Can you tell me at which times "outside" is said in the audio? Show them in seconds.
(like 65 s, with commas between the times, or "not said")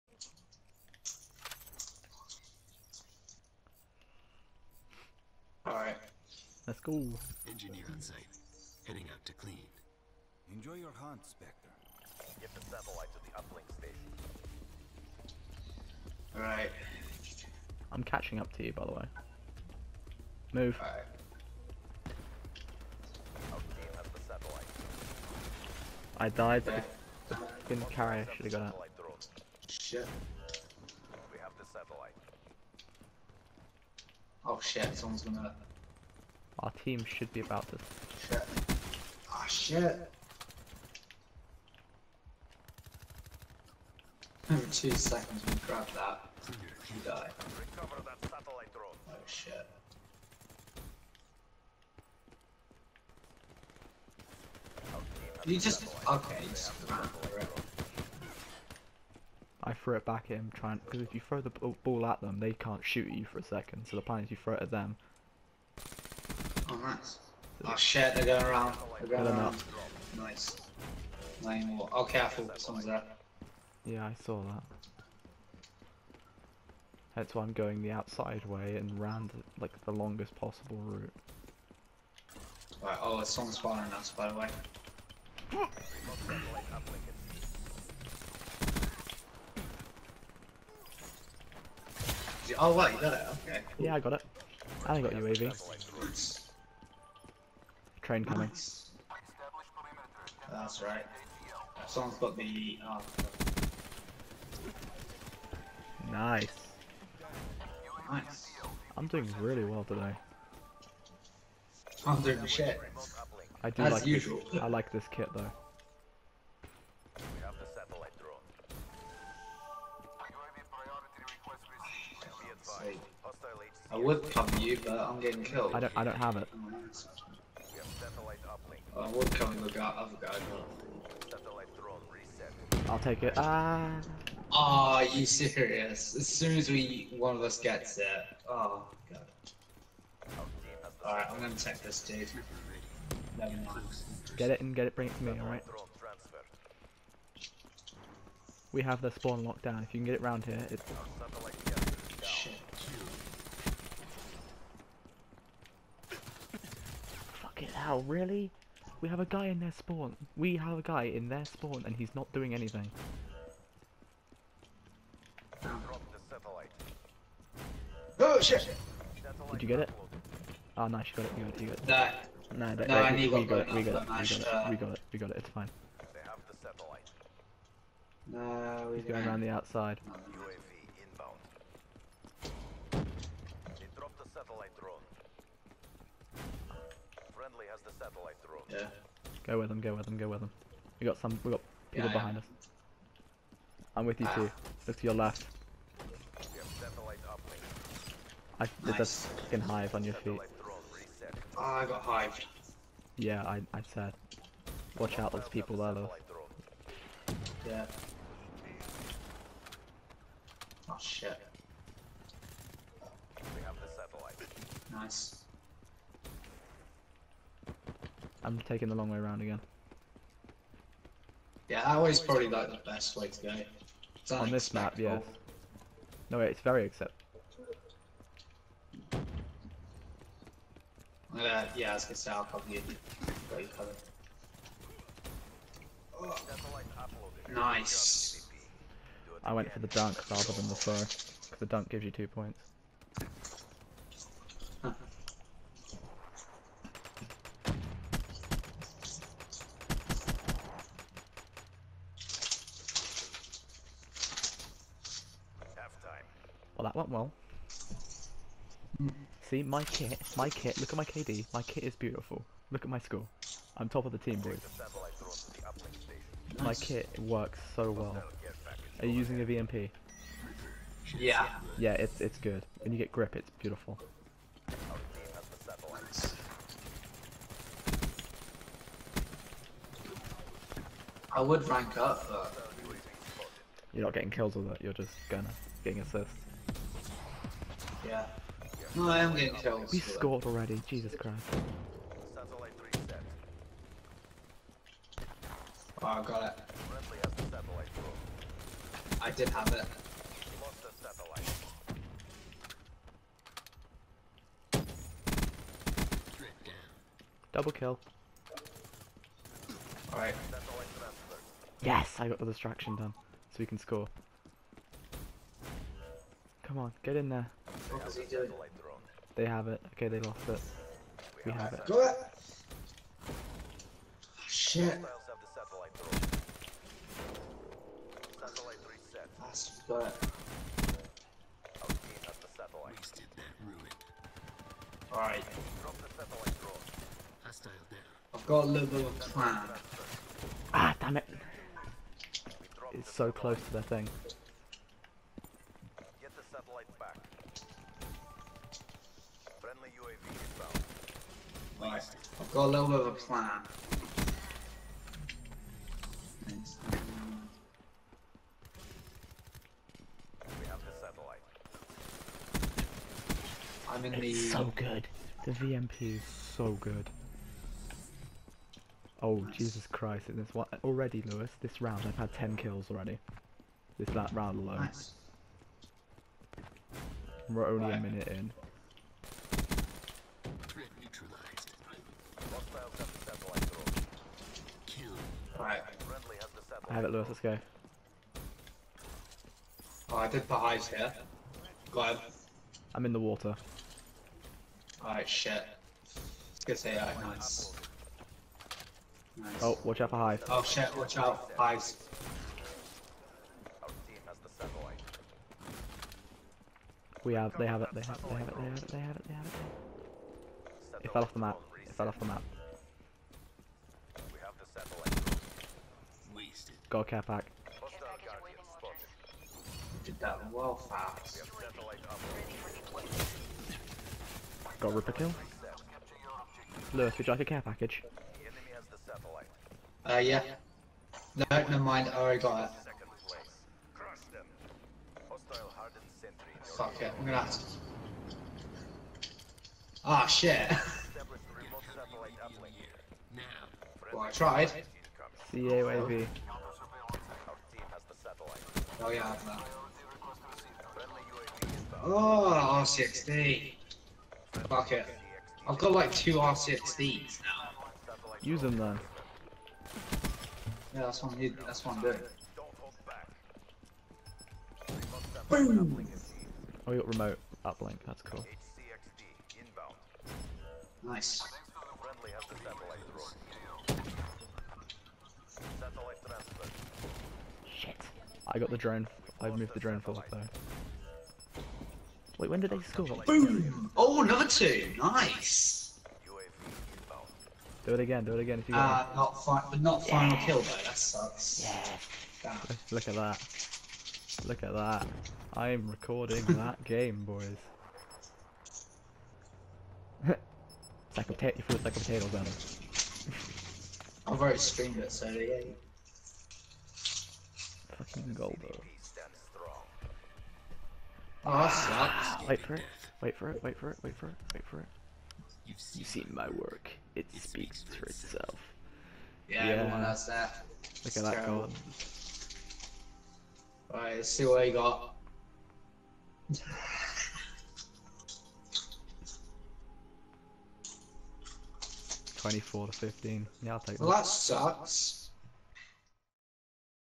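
77 s, 179 s.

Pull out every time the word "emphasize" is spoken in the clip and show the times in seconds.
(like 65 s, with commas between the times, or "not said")
not said.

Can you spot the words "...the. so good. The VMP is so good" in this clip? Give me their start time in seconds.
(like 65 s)
364 s.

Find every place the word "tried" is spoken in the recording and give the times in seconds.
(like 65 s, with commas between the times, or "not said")
444 s.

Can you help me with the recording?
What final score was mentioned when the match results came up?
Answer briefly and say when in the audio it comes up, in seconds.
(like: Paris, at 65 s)
24 to 15, at 532 s.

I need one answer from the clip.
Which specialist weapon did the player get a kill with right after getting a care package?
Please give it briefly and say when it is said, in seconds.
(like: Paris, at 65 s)
Ripper, at 424 s.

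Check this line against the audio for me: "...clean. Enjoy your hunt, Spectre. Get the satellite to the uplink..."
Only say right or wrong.
right.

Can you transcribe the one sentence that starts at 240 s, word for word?
Because the dunk gives you two points.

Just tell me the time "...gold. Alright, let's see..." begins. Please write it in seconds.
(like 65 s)
521 s.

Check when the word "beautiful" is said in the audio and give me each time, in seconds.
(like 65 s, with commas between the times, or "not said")
261 s, 273 s.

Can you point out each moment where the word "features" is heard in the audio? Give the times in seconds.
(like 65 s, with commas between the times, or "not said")
not said.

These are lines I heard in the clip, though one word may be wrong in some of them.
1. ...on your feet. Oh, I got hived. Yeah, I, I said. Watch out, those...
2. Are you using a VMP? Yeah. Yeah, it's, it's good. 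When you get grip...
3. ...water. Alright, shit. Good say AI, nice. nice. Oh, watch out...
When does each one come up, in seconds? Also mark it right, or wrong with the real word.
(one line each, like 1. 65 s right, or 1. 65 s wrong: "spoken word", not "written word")
1. 199 s right
2. 268 s right
3. 393 s right.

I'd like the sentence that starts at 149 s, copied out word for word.
If you can get it round here, it's...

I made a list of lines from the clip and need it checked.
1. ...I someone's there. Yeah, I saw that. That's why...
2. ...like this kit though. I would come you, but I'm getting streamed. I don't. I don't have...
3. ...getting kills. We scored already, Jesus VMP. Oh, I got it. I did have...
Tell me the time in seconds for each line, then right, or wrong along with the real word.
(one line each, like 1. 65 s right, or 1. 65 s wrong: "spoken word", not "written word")
1. 72 s right
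2. 114 s wrong: "killed", not "streamed"
3. 289 s wrong: "Christ", not "VMP".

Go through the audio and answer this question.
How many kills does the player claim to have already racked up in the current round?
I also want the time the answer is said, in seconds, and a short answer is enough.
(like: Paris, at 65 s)
10, at 372 s.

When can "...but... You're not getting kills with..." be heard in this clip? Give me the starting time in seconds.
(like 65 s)
282 s.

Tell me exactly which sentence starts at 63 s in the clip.
So the plan is you throw it at them, nice.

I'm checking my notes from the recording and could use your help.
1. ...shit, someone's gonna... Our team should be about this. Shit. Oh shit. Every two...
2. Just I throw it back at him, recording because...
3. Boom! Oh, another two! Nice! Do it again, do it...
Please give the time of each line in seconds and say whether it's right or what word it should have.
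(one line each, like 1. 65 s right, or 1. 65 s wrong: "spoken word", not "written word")
1. 34 s right
2. 56 s wrong: "trying", not "recording"
3. 483 s right.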